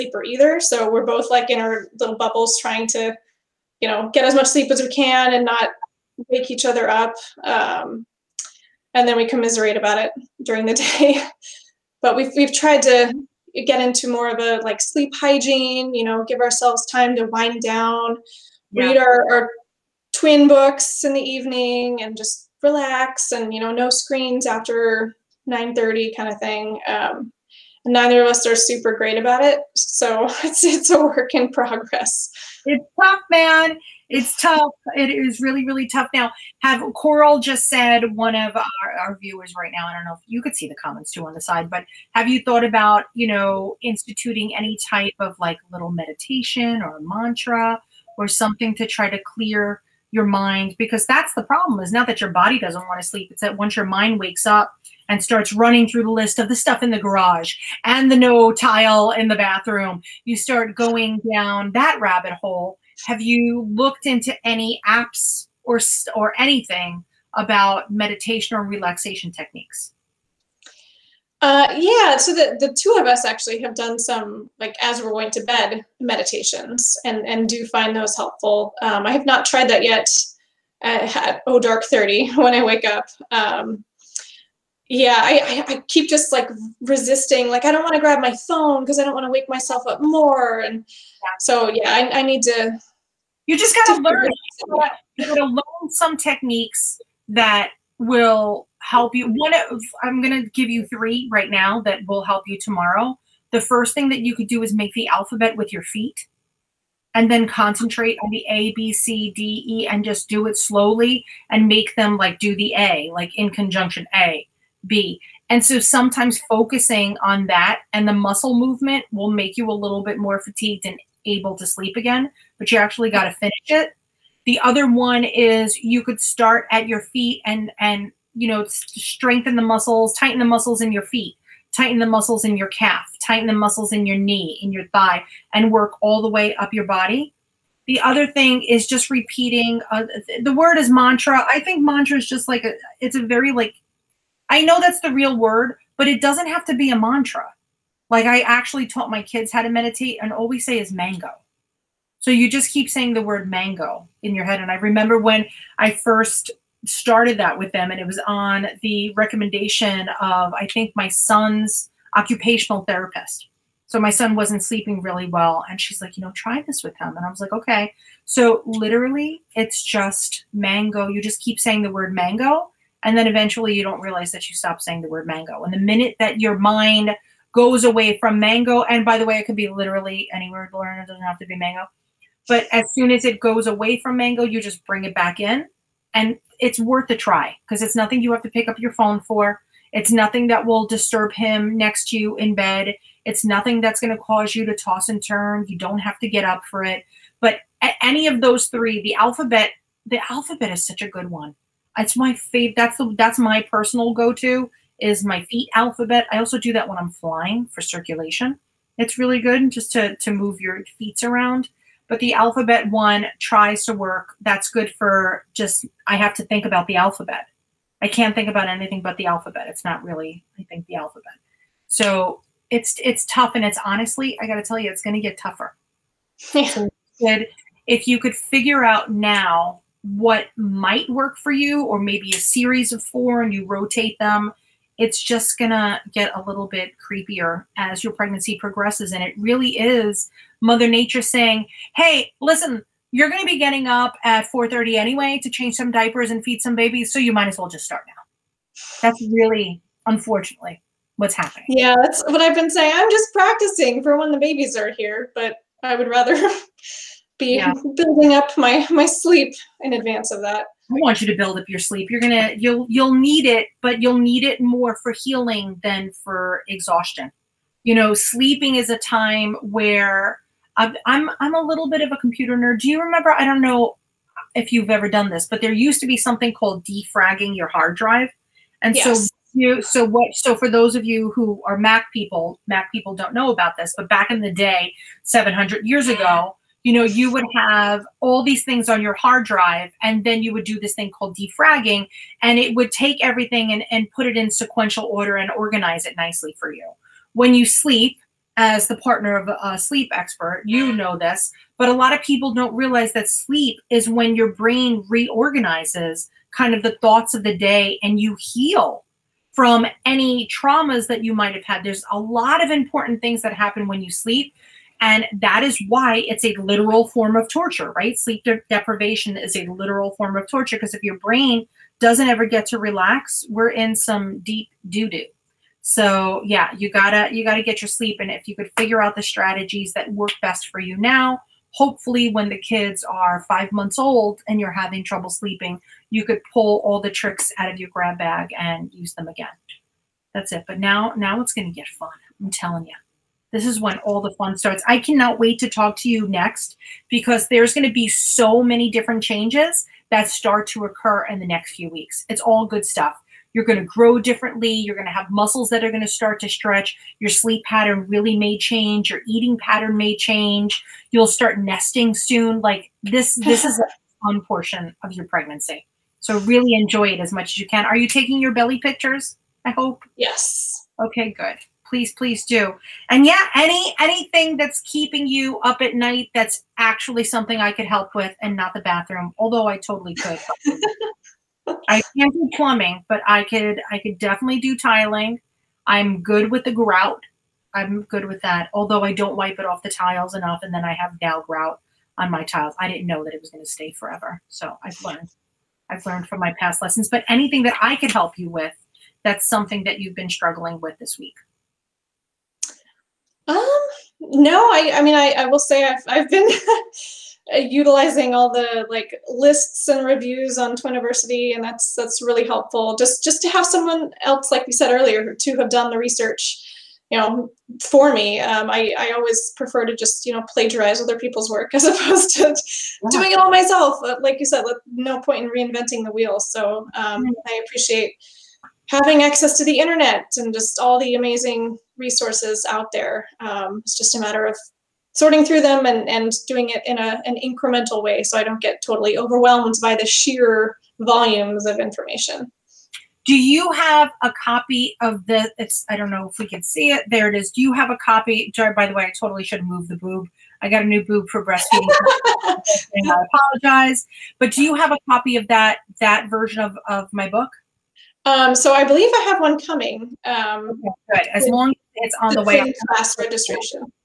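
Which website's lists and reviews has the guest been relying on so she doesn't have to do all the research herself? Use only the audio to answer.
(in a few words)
Twiniversity.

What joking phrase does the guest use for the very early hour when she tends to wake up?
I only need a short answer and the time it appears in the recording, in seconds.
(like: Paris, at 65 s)
Oh Dark 30, at 81 s.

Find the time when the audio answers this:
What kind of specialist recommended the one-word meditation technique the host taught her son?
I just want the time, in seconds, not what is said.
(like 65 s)
162 s.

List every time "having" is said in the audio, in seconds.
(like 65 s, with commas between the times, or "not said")
334 s, 428 s.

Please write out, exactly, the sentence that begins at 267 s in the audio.
You know, sleeping is a time where I'm I'm, I'm a little bit of a computer nerd.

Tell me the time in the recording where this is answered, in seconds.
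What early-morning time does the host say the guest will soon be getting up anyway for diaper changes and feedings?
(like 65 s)
244 s.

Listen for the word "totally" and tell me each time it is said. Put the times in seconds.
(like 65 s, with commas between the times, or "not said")
379 s, 438 s, 449 s.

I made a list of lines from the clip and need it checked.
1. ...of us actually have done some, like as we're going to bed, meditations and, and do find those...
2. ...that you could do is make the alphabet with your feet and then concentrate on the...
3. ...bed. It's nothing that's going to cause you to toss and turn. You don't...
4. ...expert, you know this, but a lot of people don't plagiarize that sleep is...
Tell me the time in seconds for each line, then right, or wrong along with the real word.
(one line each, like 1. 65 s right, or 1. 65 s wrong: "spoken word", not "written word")
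1. 72 s right
2. 104 s right
3. 192 s right
4. 300 s wrong: "realize", not "plagiarize".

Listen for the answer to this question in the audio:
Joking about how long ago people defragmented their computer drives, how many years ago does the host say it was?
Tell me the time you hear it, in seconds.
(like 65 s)
285 s.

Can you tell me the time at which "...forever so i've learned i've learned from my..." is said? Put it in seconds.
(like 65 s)
393 s.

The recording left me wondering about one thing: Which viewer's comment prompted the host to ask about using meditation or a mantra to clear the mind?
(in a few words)
Coral.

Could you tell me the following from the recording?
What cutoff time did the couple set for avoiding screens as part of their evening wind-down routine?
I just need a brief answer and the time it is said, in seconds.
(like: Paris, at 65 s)
9:30, at 25 s.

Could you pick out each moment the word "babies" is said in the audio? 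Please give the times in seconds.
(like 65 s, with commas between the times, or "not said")
246 s, 254 s.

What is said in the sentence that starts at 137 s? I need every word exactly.
The other thing is just repeating uh, the word is mantra.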